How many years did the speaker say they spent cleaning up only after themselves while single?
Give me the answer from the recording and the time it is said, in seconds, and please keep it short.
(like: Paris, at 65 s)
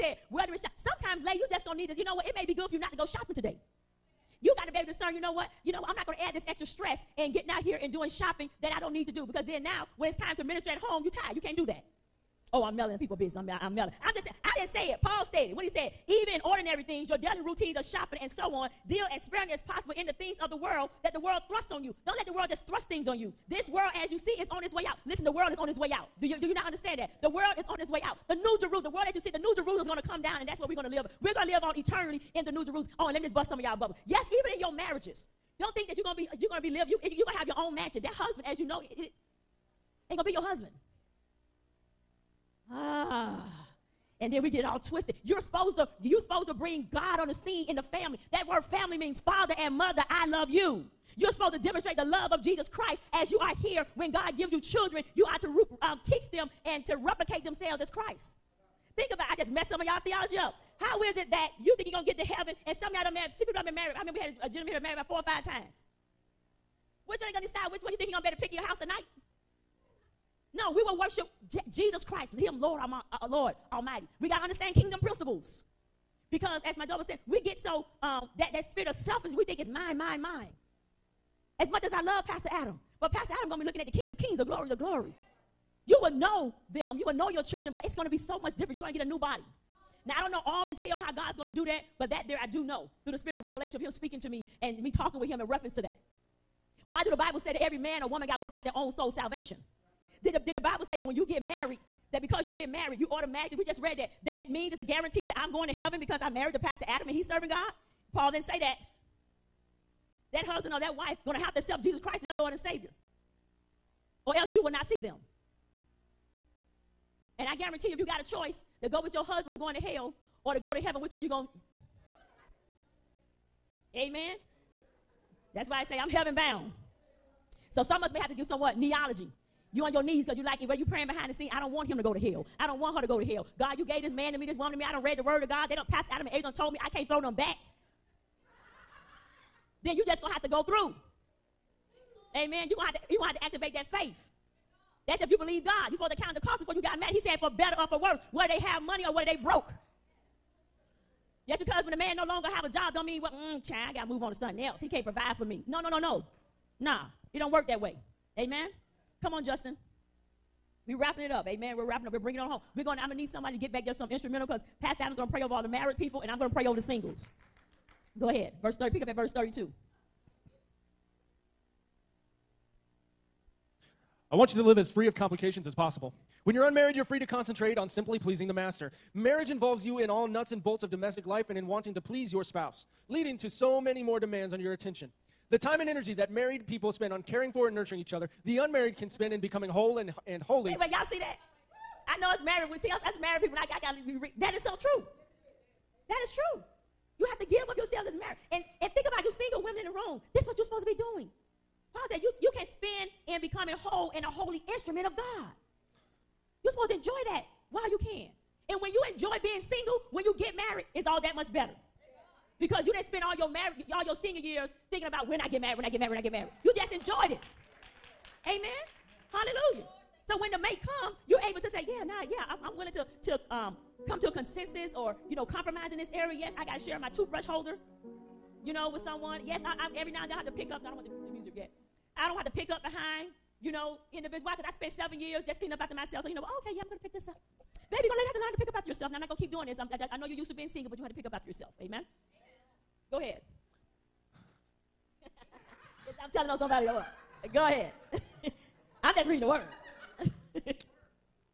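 7, at 234 s.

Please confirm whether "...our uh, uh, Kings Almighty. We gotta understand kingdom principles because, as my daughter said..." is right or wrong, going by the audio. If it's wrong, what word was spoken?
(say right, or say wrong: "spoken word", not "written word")
wrong: "Lord", not "Kings".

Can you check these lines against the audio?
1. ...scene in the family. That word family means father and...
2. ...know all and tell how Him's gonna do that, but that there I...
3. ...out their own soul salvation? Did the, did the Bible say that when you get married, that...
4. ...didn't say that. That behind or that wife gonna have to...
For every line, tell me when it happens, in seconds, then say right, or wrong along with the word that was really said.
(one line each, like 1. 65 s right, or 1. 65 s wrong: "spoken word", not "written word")
1. 47 s right
2. 90 s wrong: "God", not "Him"
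3. 98 s right
4. 108 s wrong: "husband", not "behind".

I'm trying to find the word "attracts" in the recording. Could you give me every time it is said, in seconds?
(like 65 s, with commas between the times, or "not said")
not said.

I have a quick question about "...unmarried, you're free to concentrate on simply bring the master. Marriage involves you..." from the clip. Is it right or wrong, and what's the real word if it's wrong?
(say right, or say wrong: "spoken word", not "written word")
wrong: "pleasing", not "bring".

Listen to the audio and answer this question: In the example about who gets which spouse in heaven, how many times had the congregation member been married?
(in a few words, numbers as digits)
4 or 5.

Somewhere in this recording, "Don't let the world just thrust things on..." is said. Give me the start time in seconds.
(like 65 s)
22 s.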